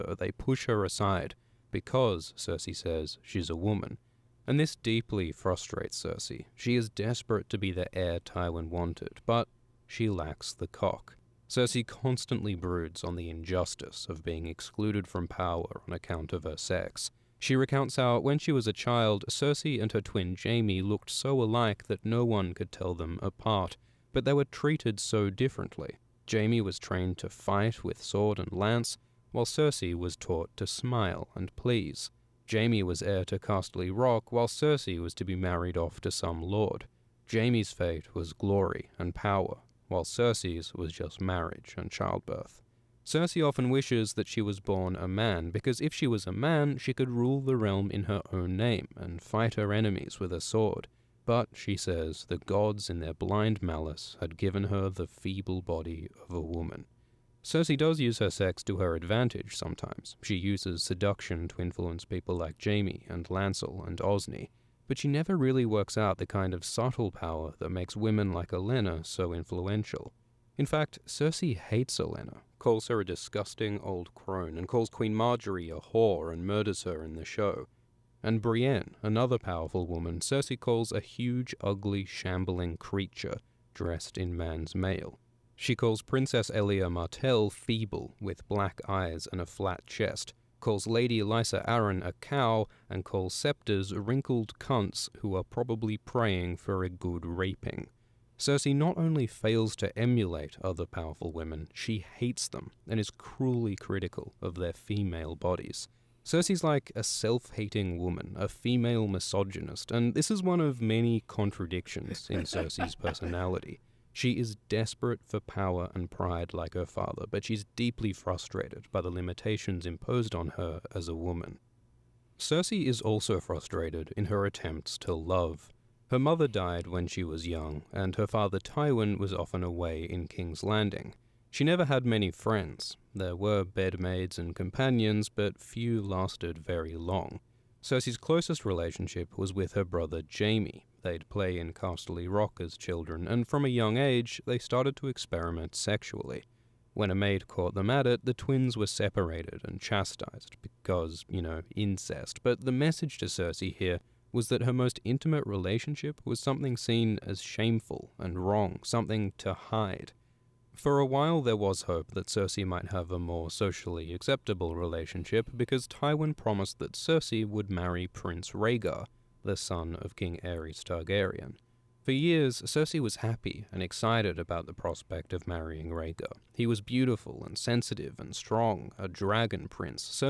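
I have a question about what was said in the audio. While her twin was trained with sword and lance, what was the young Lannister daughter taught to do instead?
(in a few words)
smile and please.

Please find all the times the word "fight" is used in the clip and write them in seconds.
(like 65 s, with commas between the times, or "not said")
27 s, 49 s.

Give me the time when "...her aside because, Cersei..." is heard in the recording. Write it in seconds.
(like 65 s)
0 s.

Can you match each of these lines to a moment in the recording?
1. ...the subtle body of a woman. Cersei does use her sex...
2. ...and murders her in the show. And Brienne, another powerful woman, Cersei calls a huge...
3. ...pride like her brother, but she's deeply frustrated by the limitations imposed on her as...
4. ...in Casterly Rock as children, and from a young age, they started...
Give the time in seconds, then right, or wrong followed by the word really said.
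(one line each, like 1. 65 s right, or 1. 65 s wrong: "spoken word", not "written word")
1. 54 s wrong: "feeble", not "subtle"
2. 76 s right
3. 116 s wrong: "father", not "brother"
4. 141 s right.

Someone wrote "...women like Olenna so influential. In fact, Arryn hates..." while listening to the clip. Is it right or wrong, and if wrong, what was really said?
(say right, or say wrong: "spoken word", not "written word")
wrong: "Cersei", not "Arryn".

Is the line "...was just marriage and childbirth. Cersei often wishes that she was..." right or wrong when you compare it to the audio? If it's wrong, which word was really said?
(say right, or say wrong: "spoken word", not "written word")
right.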